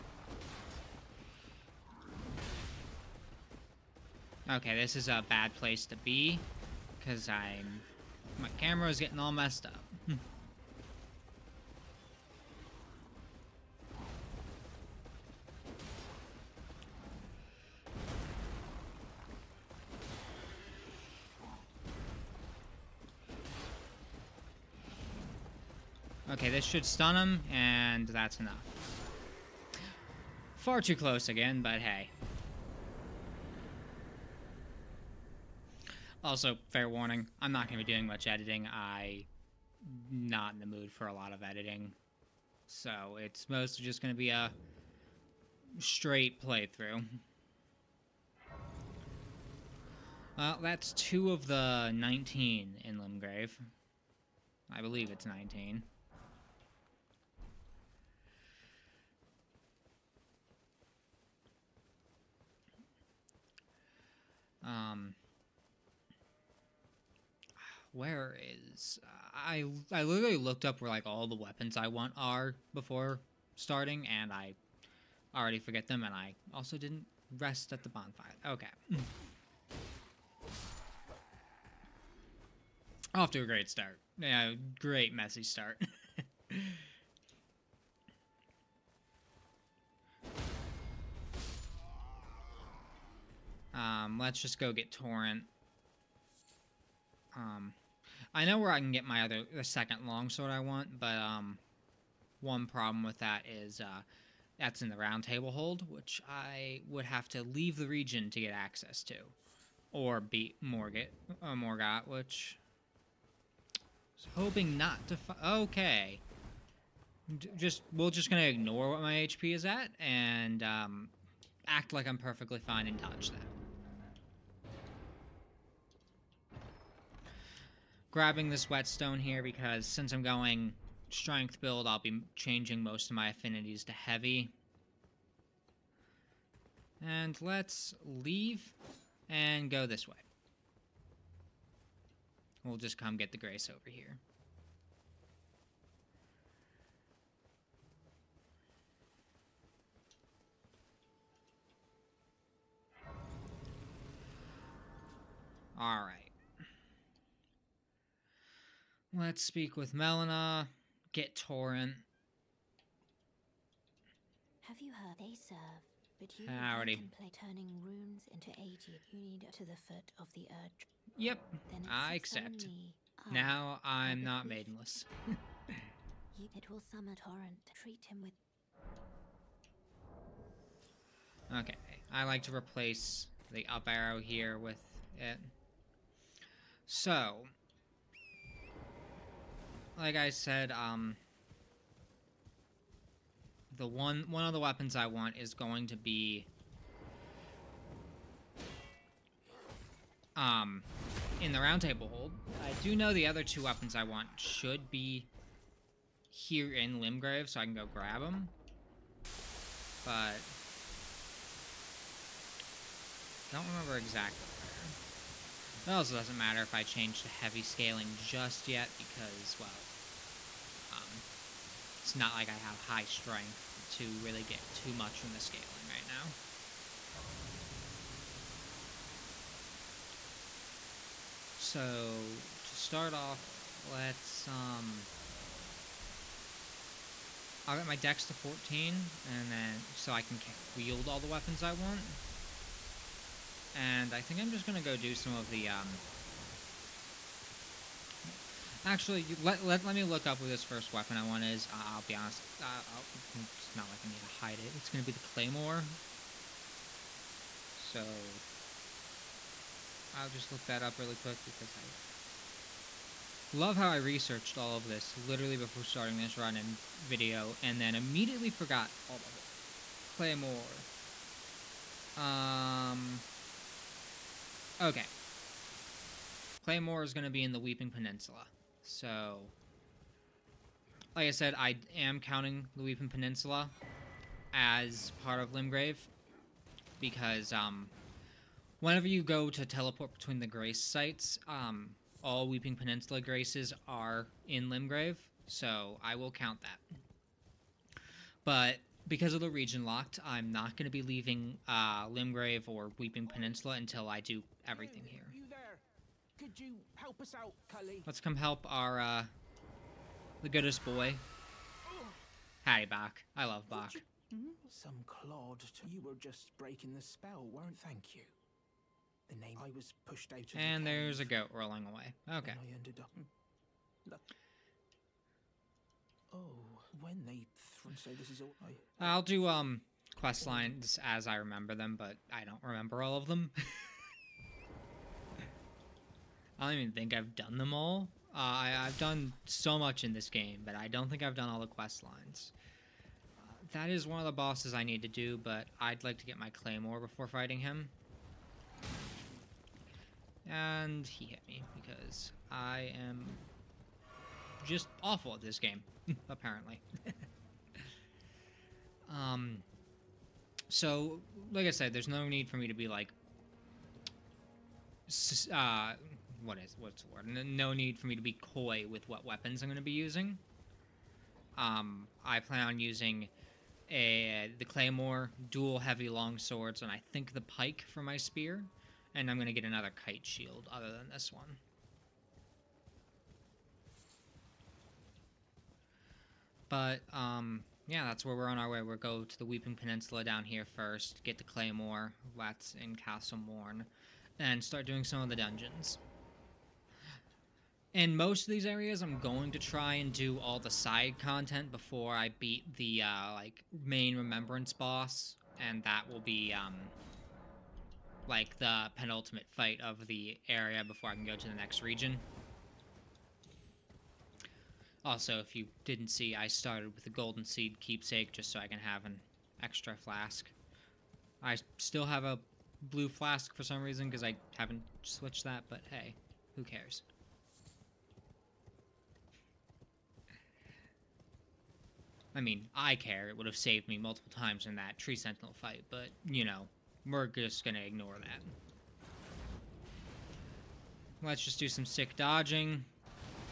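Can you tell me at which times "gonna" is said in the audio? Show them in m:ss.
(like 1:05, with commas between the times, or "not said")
1:58, 4:04.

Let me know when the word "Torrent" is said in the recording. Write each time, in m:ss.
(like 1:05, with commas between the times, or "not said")
1:34, 2:41, 2:57.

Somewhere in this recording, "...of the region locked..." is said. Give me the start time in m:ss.
4:59.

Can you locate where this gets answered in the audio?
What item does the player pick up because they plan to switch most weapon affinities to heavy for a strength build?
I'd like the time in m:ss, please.
2:08.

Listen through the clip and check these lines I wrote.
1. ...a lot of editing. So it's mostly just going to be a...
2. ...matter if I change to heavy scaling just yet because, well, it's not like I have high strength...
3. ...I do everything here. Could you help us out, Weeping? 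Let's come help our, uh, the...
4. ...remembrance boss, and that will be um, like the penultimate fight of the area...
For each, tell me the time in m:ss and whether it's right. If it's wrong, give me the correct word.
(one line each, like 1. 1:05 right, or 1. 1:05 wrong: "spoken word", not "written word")
1. 0:41 right
2. 3:36 right
3. 5:04 wrong: "Cully", not "Weeping"
4. 6:44 right.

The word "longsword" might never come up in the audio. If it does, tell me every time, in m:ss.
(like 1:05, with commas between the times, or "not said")
1:40, 6:16.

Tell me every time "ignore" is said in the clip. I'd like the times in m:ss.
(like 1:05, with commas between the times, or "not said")
1:58, 7:17.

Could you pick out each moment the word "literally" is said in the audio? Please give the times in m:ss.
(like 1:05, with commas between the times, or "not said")
1:10, 4:25.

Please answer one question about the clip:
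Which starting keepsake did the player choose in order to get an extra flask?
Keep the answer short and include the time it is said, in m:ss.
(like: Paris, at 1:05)
golden seed, at 6:57.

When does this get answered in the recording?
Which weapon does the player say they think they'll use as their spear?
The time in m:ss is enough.
6:17.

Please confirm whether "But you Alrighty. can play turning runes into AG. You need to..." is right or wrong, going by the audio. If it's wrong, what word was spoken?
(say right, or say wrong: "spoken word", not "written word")
right.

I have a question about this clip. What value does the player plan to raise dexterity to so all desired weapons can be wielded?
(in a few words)
14.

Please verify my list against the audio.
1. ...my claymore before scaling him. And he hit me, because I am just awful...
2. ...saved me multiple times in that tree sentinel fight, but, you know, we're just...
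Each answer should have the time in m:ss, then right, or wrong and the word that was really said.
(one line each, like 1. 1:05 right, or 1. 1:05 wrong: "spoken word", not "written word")
1. 5:46 wrong: "fighting", not "scaling"
2. 7:13 right.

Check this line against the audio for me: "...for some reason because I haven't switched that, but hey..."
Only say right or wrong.
right.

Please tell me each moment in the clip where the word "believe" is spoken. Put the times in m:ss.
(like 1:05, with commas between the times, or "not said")
0:54.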